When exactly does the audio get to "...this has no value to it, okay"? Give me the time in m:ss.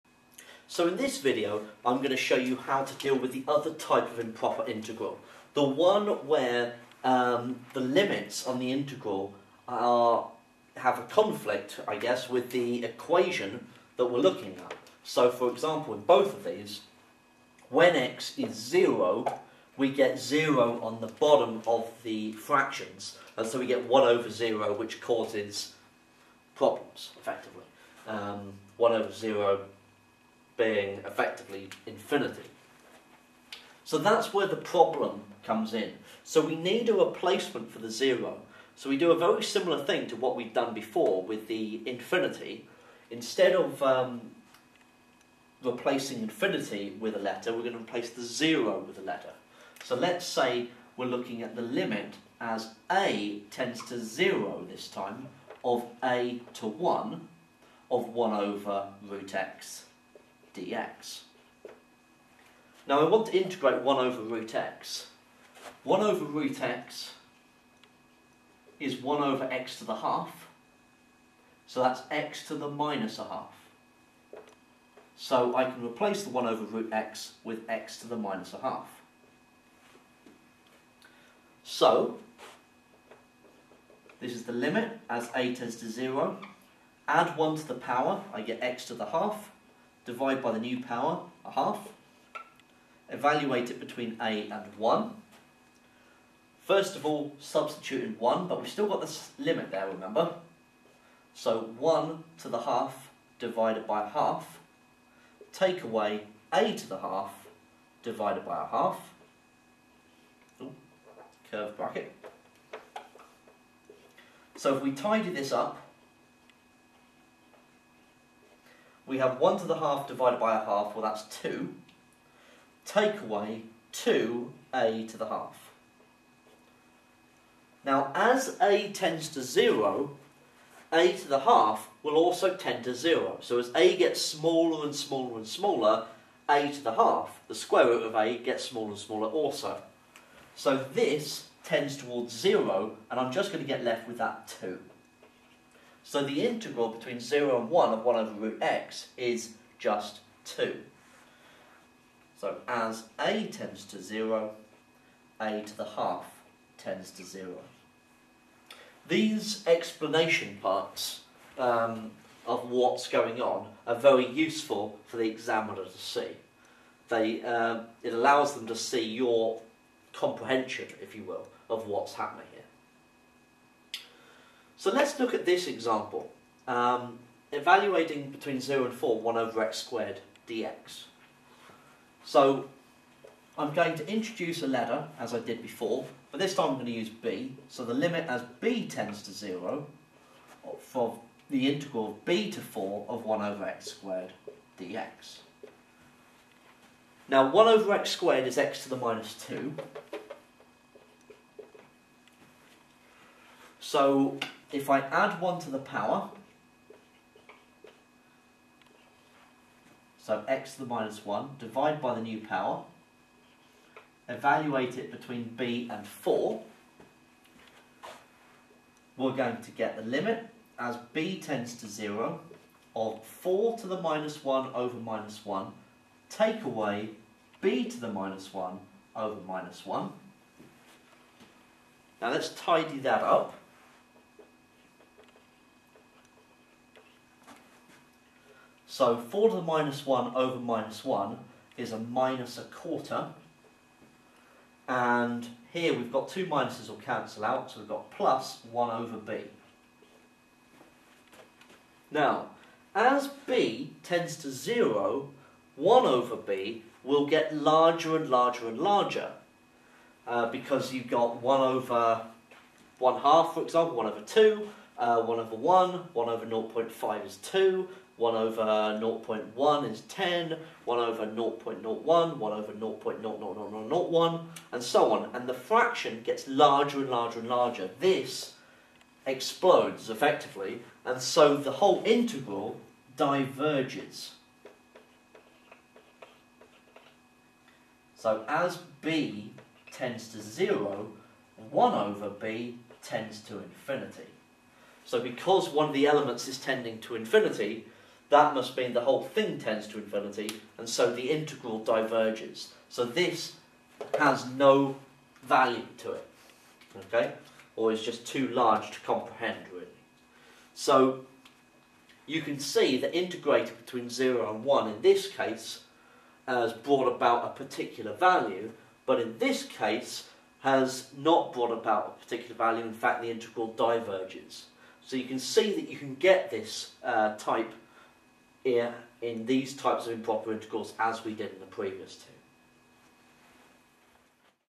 5:03.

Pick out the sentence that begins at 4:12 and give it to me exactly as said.
Now, as b tends to 0, 1 over b will get larger and larger and larger.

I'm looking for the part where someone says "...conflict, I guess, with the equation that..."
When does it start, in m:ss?
0:11.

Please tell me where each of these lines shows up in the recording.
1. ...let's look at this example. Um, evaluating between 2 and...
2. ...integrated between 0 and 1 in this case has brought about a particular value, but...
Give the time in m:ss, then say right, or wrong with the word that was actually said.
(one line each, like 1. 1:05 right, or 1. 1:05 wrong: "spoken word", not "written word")
1. 2:54 wrong: "0", not "2"
2. 5:13 right.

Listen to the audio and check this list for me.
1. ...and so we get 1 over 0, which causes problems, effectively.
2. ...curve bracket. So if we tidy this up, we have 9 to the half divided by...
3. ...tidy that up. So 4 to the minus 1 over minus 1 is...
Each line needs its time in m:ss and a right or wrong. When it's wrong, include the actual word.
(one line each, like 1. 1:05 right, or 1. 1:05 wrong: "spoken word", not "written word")
1. 0:23 right
2. 1:51 wrong: "1", not "9"
3. 3:52 right.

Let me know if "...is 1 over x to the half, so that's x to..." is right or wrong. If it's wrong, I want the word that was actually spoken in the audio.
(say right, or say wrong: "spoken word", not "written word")
right.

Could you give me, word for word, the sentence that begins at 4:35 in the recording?
And the fraction gets larger and larger and larger.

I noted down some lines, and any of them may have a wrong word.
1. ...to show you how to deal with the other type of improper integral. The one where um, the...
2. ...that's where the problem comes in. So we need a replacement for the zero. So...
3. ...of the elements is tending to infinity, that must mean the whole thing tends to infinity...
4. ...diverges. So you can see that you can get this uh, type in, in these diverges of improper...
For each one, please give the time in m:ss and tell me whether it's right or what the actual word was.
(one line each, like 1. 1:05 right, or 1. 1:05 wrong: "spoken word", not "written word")
1. 0:02 right
2. 0:33 right
3. 4:55 right
4. 5:23 wrong: "types", not "diverges".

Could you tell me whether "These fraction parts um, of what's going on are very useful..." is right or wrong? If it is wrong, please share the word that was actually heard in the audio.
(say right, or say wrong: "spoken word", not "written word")
wrong: "explanation", not "fraction".